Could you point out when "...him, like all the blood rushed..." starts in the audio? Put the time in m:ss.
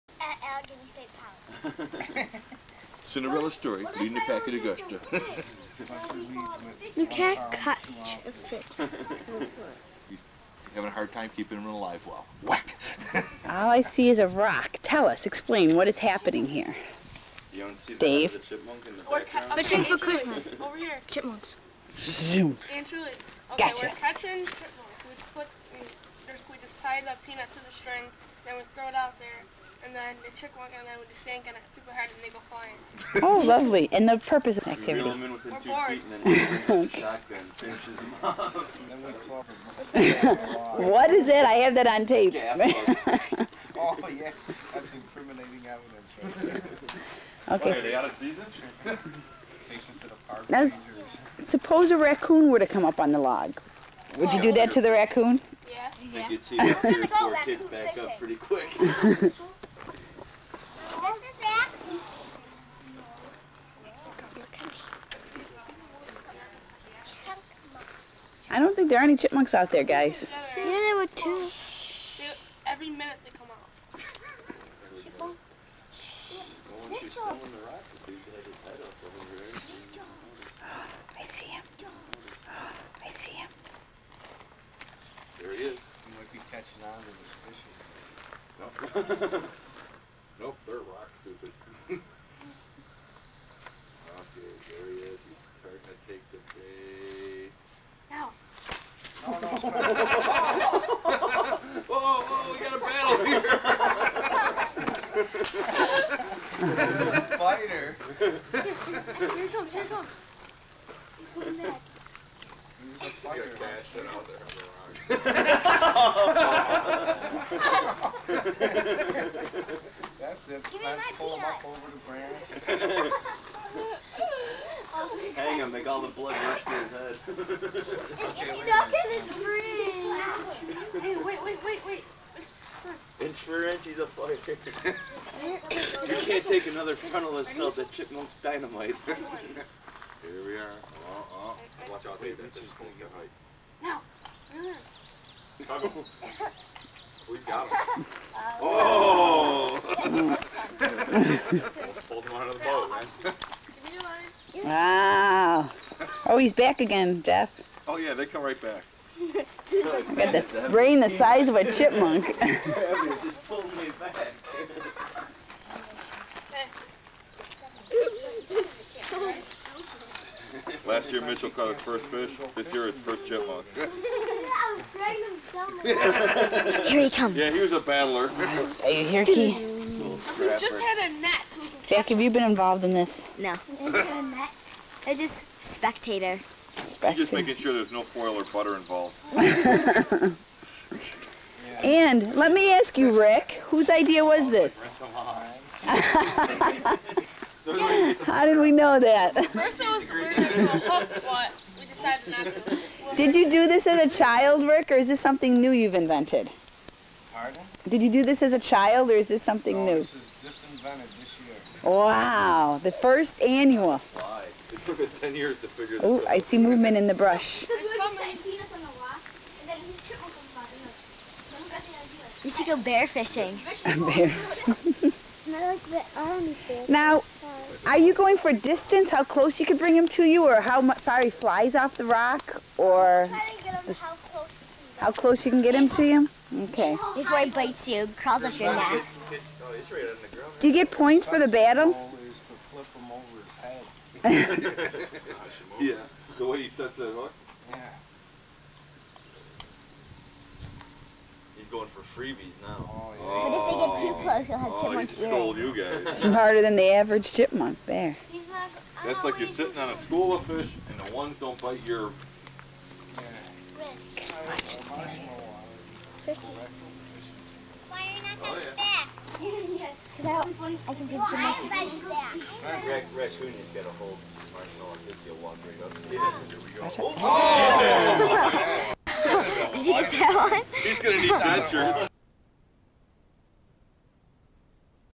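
2:05.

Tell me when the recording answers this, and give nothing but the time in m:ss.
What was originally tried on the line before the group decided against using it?
3:20.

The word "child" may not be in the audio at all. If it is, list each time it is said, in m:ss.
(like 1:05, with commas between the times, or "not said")
3:24, 3:28.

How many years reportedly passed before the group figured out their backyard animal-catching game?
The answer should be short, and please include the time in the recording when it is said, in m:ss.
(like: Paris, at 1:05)
10, at 3:35.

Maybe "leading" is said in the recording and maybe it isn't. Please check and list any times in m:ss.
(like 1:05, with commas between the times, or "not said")
0:03.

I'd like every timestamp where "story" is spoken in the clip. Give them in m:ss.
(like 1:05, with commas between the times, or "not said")
0:03.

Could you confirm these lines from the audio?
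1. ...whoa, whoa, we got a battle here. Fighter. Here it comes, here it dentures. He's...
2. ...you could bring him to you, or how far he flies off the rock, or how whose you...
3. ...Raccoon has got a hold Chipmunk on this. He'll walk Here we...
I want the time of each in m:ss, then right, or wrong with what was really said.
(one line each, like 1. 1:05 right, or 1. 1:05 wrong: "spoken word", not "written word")
1. 1:41 wrong: "comes", not "dentures"
2. 3:49 wrong: "close", not "whose"
3. 4:31 wrong: "Marshall", not "Chipmunk".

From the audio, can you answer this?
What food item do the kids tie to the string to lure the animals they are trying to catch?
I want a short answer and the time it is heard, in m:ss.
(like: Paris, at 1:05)
peanut, at 0:27.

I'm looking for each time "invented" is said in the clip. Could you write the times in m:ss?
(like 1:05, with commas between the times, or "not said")
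3:25, 3:30.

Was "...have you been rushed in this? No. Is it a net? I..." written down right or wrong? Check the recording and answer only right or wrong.
wrong.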